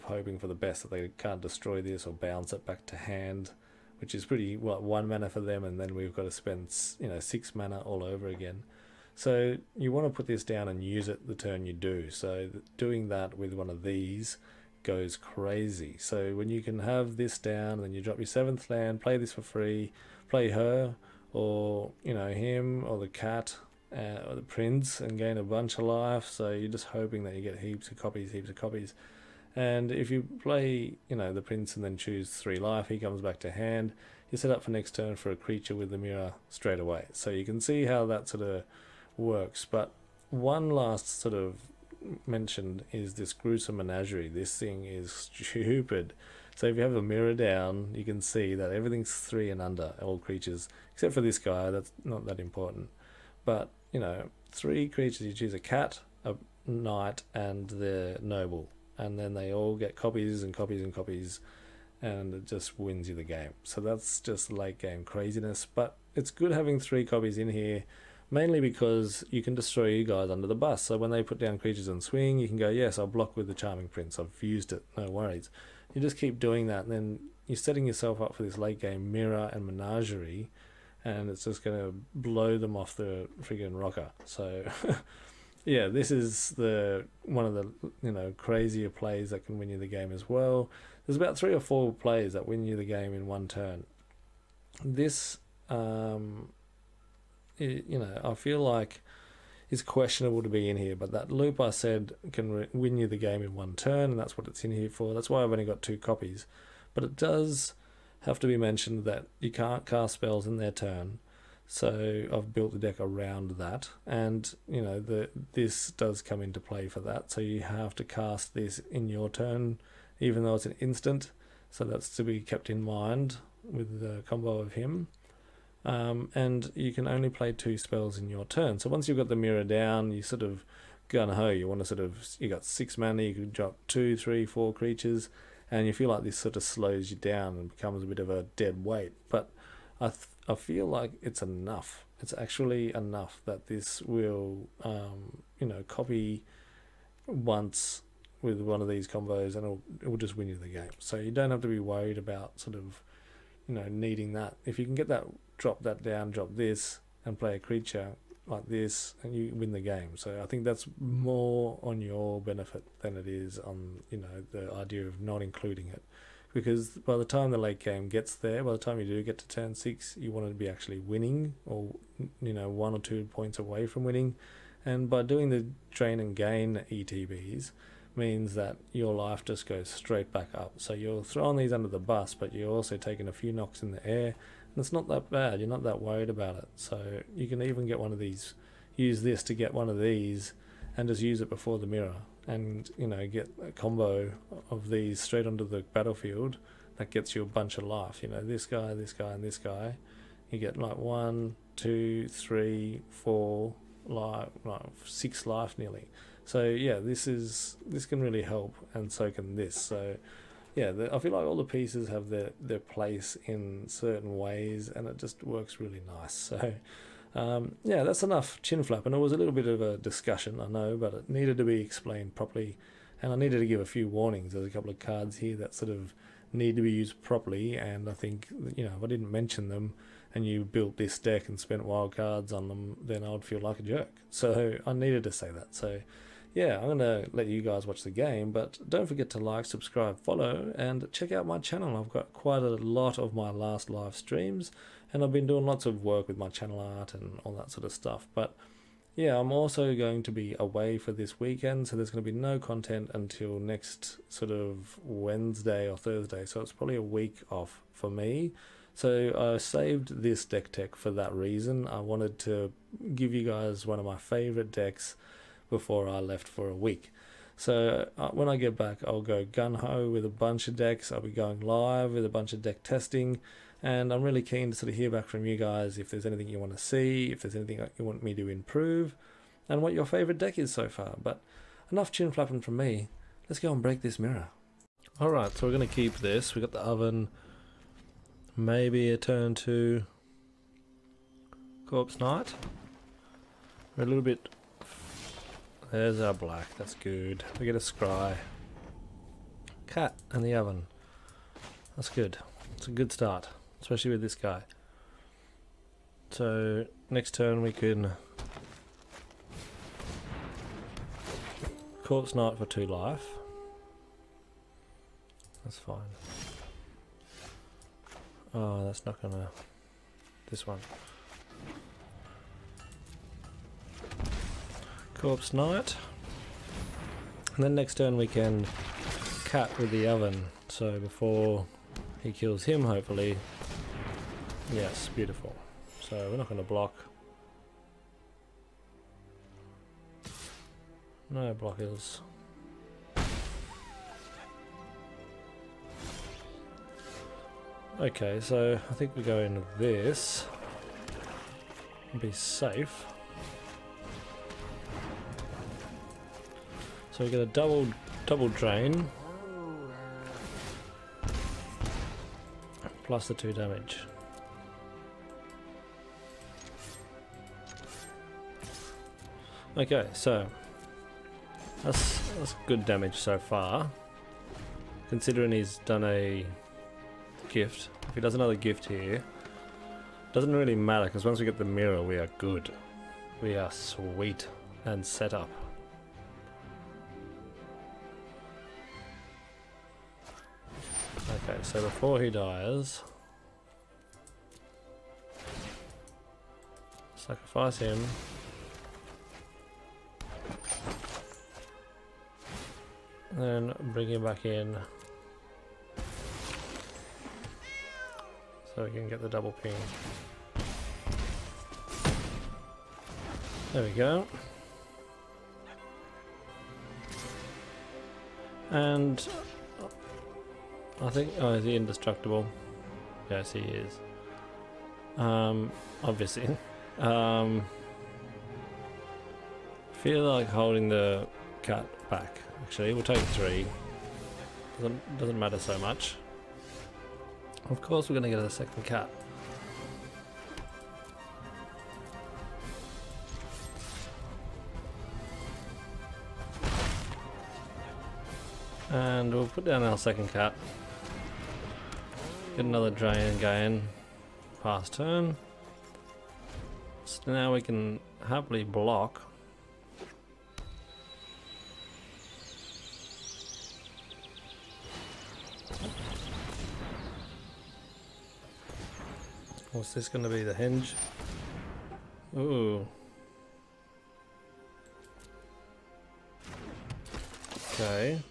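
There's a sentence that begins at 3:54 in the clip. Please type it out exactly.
So I needed to say that.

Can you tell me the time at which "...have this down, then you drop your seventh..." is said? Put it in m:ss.
0:16.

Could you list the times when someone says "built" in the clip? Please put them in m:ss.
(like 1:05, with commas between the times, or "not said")
1:52, 3:50.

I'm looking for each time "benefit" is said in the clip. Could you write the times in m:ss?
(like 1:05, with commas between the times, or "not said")
2:42.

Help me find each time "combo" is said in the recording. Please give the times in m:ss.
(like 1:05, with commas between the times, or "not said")
2:04, 2:29, 3:13.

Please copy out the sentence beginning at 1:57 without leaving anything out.
So you have to cast this in your turn, even though it's an instant.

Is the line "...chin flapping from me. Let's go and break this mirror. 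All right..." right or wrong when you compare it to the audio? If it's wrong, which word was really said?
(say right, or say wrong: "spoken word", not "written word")
right.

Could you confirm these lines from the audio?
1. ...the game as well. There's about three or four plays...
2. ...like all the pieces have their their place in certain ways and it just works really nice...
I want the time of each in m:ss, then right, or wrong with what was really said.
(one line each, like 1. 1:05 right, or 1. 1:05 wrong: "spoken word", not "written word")
1. 1:29 right
2. 3:31 right.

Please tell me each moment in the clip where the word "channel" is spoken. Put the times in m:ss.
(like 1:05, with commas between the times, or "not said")
4:01, 4:06.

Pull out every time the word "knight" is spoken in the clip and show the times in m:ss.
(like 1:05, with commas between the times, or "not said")
0:56, 4:52, 5:12, 5:25.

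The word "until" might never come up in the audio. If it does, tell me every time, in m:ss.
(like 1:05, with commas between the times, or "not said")
4:13.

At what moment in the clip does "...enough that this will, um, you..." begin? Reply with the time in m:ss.
2:22.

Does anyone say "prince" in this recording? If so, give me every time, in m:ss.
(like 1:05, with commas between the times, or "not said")
0:24, 0:31, 1:13.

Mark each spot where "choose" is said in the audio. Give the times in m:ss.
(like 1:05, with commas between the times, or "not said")
0:31, 0:55.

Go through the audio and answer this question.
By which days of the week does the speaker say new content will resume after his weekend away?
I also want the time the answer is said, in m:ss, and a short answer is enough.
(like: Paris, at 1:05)
Wednesday or Thursday, at 4:15.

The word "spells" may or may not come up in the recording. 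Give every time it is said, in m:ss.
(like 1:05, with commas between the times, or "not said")
1:50, 2:07.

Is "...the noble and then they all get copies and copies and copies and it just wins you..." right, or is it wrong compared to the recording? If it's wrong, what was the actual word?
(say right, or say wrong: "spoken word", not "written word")
right.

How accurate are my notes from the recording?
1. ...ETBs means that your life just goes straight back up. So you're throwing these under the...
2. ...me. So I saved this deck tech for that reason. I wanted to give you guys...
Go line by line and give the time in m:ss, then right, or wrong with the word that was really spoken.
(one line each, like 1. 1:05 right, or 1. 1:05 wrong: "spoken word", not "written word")
1. 2:56 right
2. 4:18 right.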